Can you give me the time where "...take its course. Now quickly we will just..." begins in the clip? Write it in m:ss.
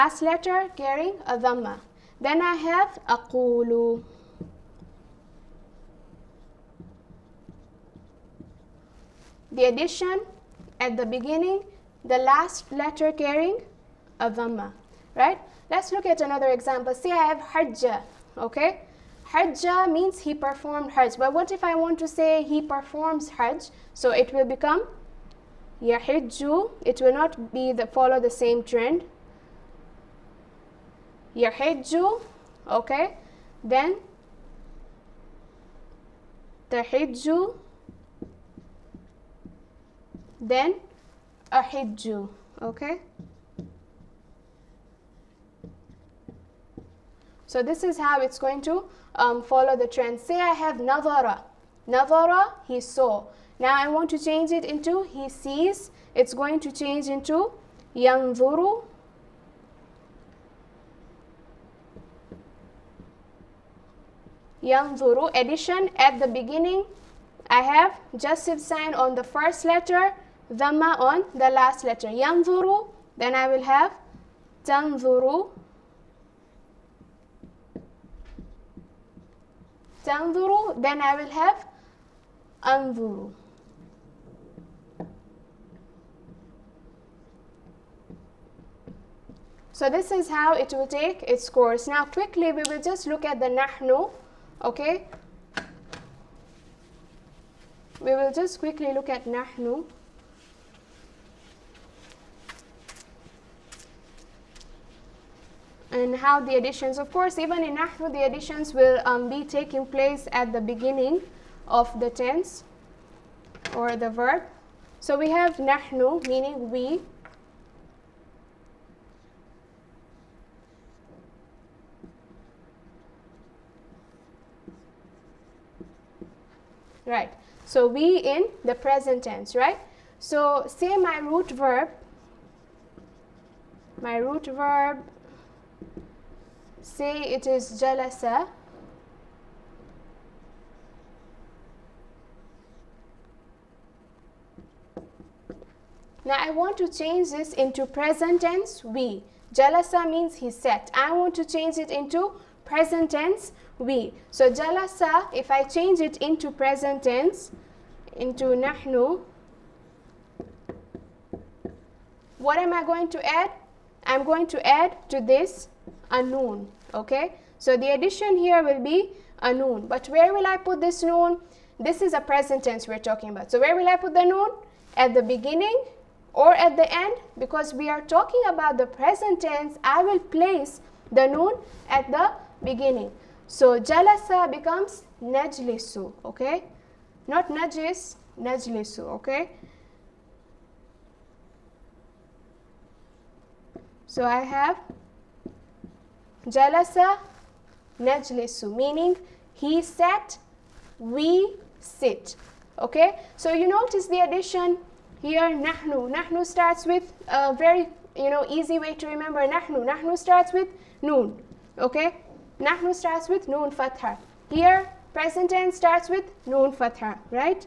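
1:30.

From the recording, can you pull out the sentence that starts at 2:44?
I'm going to add to this anun.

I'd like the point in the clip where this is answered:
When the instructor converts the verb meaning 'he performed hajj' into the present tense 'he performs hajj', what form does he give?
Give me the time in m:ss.
0:25.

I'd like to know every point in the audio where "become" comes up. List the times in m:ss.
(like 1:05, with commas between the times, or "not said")
0:24, 3:04.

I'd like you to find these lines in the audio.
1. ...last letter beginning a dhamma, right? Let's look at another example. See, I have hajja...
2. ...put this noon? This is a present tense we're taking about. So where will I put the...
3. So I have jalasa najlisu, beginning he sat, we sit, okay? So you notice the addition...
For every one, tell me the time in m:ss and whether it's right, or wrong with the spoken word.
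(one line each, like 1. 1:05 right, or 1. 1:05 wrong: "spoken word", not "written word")
1. 0:12 wrong: "carrying", not "beginning"
2. 2:50 wrong: "talking", not "taking"
3. 3:14 wrong: "meaning", not "beginning".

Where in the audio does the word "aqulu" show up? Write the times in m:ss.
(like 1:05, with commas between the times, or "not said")
0:03.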